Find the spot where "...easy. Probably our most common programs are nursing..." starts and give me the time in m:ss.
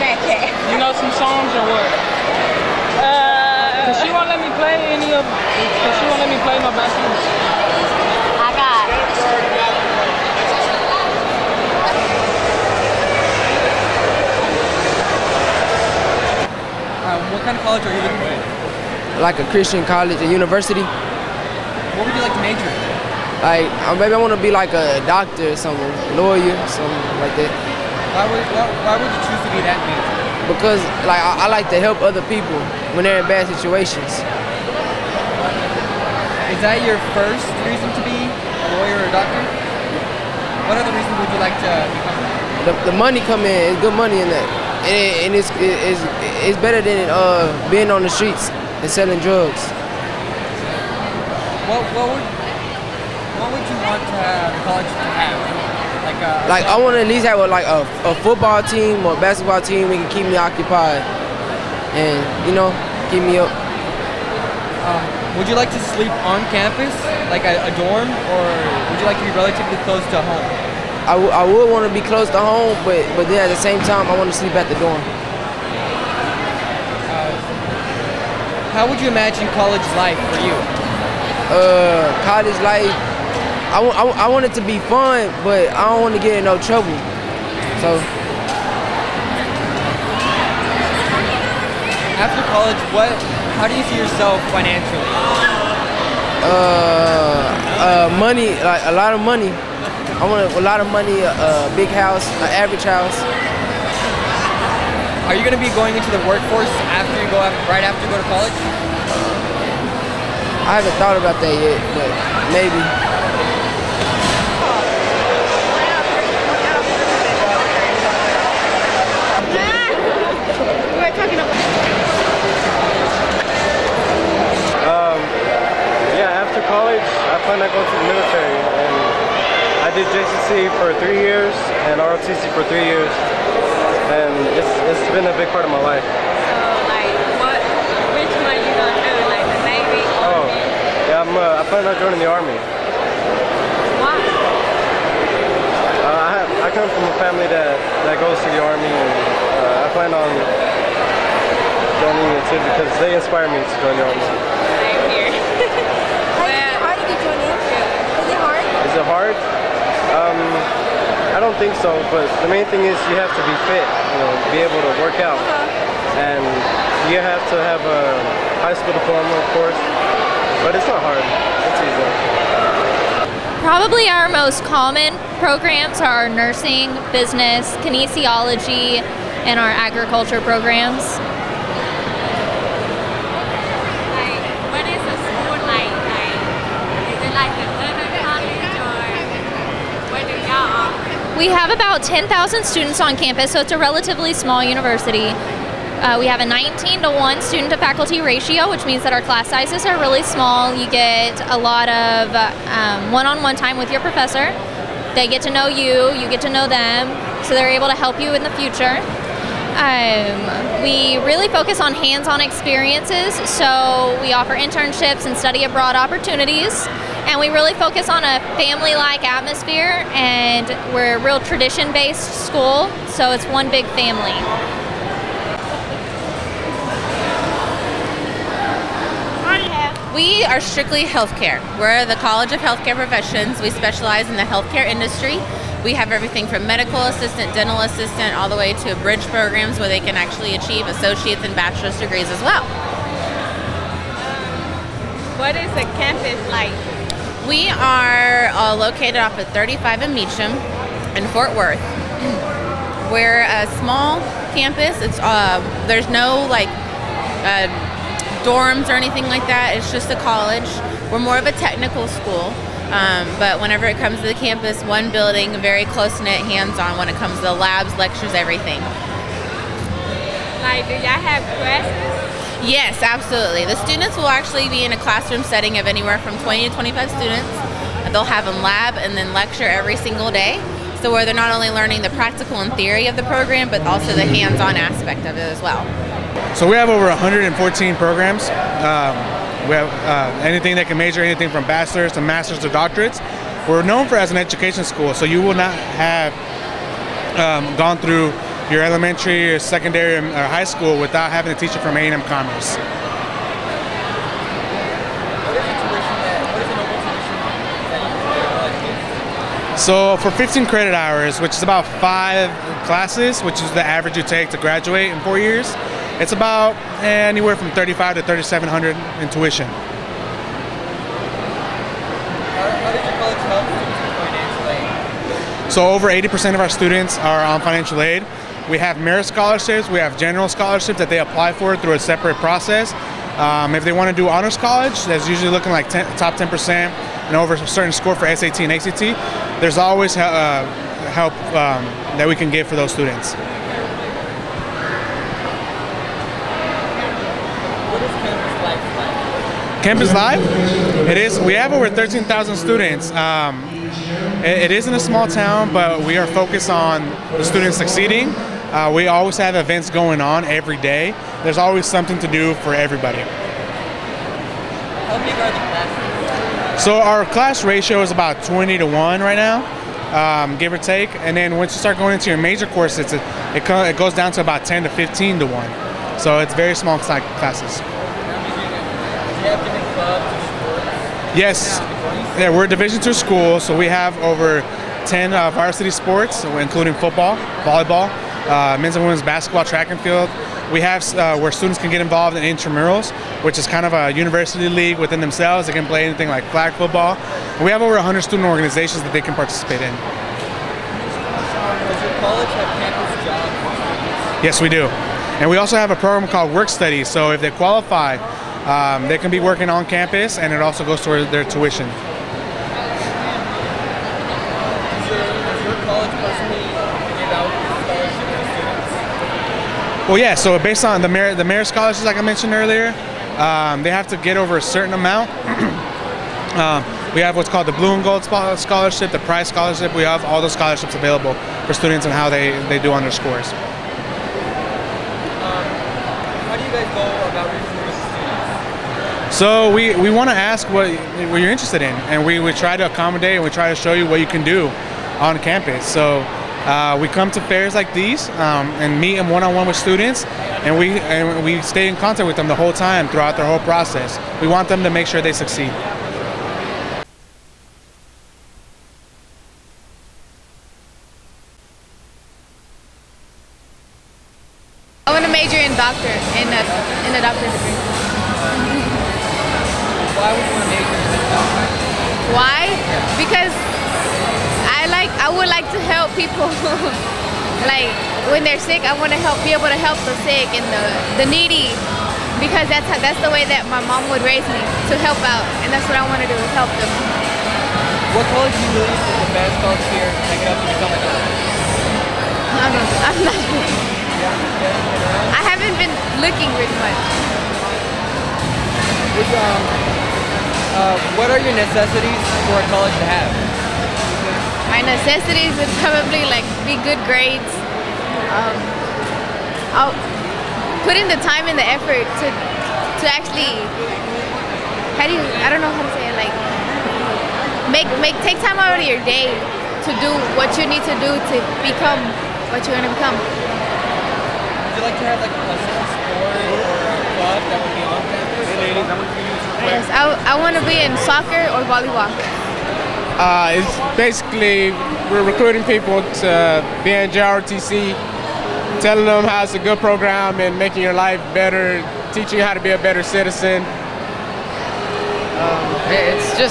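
2:51.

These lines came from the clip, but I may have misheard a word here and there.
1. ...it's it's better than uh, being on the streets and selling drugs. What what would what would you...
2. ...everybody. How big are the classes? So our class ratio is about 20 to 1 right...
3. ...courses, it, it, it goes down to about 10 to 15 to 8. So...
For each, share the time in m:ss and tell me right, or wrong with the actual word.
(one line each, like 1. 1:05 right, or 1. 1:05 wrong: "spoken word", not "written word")
1. 0:45 right
2. 6:02 right
3. 6:12 wrong: "1", not "8".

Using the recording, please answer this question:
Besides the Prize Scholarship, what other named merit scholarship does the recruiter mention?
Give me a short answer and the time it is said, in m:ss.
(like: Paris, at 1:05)
Blue and Gold Scholarship, at 7:07.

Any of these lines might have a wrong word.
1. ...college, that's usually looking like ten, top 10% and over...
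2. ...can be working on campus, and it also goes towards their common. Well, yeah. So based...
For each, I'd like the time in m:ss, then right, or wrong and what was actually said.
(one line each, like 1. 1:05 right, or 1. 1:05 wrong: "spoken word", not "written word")
1. 5:34 right
2. 6:49 wrong: "tuition", not "common".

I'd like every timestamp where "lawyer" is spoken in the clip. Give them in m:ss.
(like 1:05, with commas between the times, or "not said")
0:26, 0:38.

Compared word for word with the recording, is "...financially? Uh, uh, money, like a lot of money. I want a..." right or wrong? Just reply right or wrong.
right.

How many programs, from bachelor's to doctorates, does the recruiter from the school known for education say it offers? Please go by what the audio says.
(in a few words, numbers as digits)
over 114.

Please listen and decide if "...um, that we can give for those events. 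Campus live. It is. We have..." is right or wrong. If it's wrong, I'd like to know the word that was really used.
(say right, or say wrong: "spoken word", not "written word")
wrong: "students", not "events".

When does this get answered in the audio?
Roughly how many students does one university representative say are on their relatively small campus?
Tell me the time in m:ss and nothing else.
3:12.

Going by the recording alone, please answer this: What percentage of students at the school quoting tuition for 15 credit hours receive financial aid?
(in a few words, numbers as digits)
over 80%.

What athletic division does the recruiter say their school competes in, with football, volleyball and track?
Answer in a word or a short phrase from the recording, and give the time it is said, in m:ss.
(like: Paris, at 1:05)
Division 2, at 6:22.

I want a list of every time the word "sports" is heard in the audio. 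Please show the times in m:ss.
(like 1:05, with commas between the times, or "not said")
6:25, 8:45.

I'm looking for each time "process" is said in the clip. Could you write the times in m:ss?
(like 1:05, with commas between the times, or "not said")
5:32, 7:33.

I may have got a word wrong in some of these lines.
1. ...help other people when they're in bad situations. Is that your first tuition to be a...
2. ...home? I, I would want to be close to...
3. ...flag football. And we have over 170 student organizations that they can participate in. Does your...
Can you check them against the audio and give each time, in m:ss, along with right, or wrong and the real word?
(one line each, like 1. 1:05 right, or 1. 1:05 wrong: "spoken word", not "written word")
1. 0:31 wrong: "reason", not "tuition"
2. 1:10 right
3. 6:36 wrong: "100", not "170".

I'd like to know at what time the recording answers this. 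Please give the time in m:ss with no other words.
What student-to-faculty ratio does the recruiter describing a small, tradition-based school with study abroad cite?
3:16.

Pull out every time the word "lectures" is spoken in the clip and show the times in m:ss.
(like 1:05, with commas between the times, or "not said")
4:27, 4:39.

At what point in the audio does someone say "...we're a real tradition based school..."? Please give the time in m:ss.
3:40.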